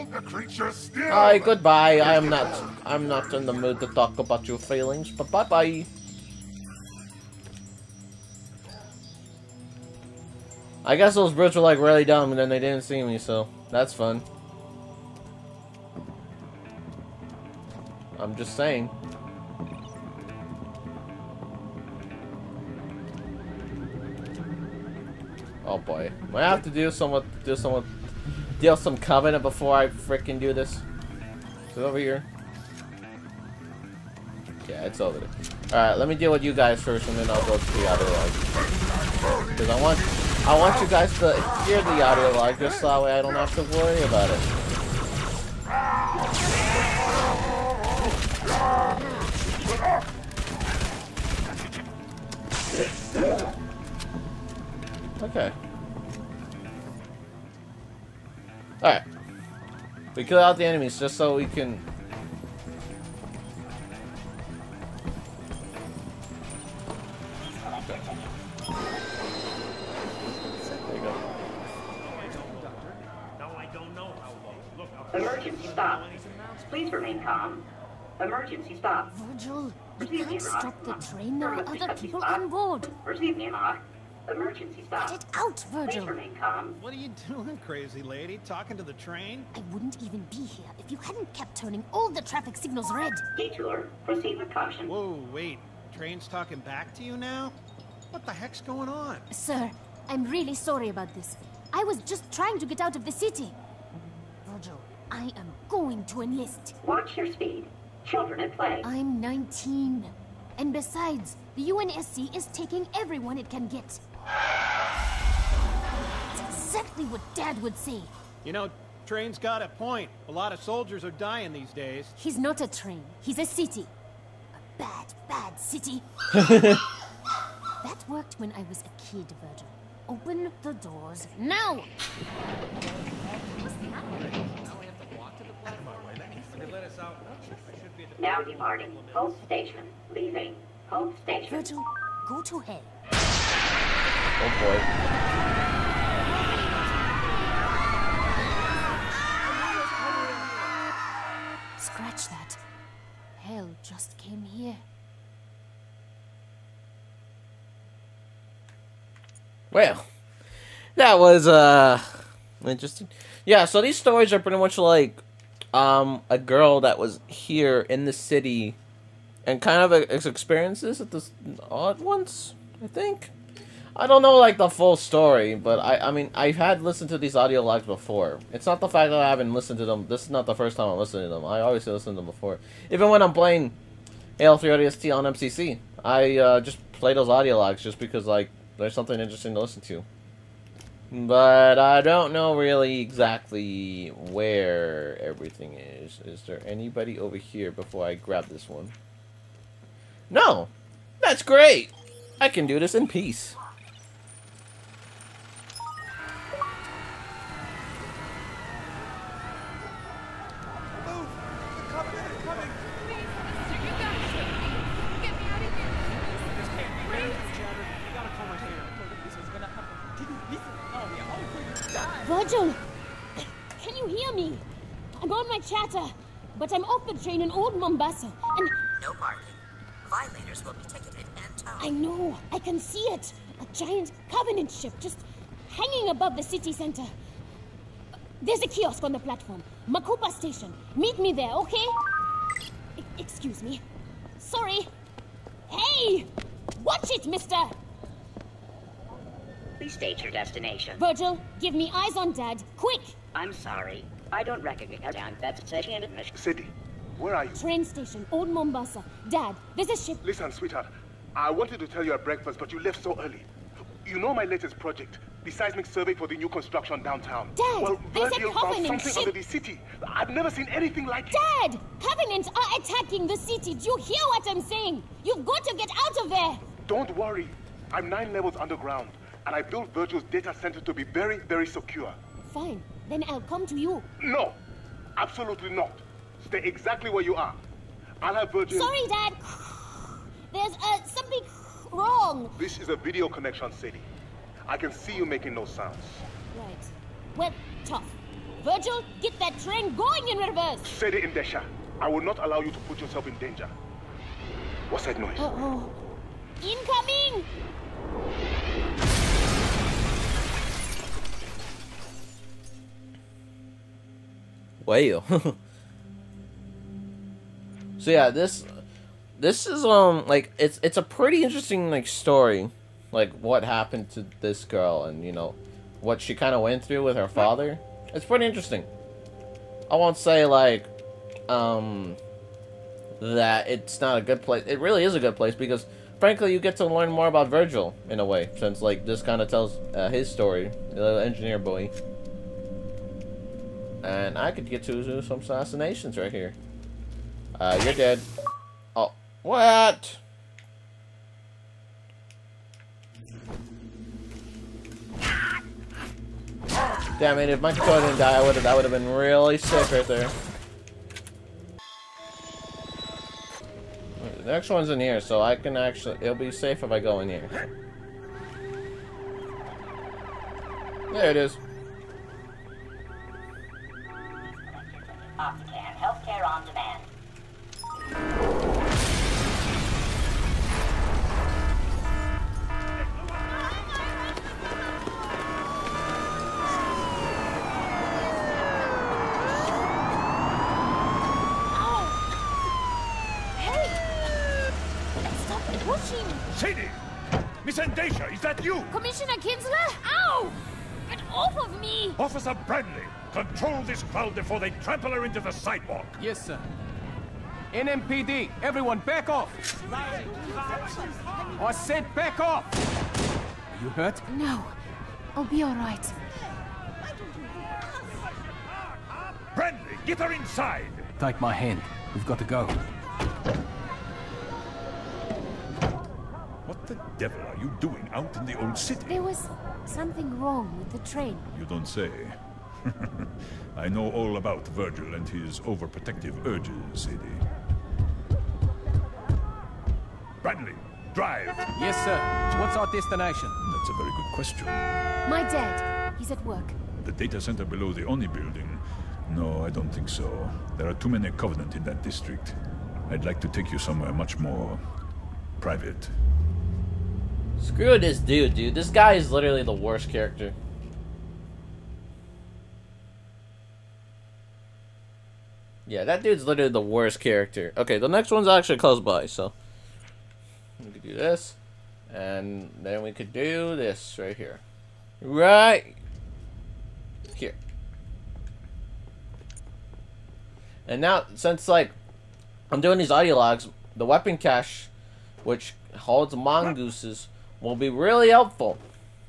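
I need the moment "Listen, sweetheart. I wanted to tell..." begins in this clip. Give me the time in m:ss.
4:20.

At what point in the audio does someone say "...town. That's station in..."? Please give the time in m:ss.
4:15.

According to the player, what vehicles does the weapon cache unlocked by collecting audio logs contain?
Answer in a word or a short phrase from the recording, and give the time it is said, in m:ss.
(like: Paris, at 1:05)
mongooses, at 8:06.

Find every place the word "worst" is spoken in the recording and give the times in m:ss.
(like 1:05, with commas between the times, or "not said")
7:39, 7:46.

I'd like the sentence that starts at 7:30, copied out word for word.
There are too many Covenant in that district.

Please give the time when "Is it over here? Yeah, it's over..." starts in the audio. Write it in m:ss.
0:31.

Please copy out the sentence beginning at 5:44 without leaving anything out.
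And I could get to some assassinations right here.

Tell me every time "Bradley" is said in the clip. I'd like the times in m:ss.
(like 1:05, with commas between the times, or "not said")
6:59, 7:20.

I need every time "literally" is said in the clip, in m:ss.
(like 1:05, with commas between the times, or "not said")
7:39, 7:46.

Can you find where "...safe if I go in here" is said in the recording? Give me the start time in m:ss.
6:06.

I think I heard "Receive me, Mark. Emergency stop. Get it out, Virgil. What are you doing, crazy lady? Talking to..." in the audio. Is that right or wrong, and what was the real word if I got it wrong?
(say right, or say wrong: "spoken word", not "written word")
right.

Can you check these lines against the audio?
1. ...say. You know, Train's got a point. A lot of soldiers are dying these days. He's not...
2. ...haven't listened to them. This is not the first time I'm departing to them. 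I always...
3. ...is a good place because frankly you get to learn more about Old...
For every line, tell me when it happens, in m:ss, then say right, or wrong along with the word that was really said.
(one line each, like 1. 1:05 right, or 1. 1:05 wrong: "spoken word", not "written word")
1. 1:57 right
2. 2:59 wrong: "listening", not "departing"
3. 5:35 wrong: "Virgil", not "Old".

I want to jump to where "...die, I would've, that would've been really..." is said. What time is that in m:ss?
5:58.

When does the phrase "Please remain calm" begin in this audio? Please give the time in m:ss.
1:16.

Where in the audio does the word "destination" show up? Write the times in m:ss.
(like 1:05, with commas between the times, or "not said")
4:10, 7:22.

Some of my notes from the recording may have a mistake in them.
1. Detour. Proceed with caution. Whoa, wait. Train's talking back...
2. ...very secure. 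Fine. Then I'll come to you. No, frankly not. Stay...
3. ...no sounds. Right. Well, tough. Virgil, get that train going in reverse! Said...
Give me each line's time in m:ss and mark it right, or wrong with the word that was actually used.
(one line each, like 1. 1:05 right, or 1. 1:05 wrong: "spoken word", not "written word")
1. 1:33 right
2. 4:41 wrong: "absolutely", not "frankly"
3. 4:55 right.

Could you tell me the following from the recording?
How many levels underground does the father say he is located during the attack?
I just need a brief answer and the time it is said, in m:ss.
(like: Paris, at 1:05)
9, at 4:38.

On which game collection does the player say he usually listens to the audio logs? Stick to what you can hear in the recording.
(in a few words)
MCC.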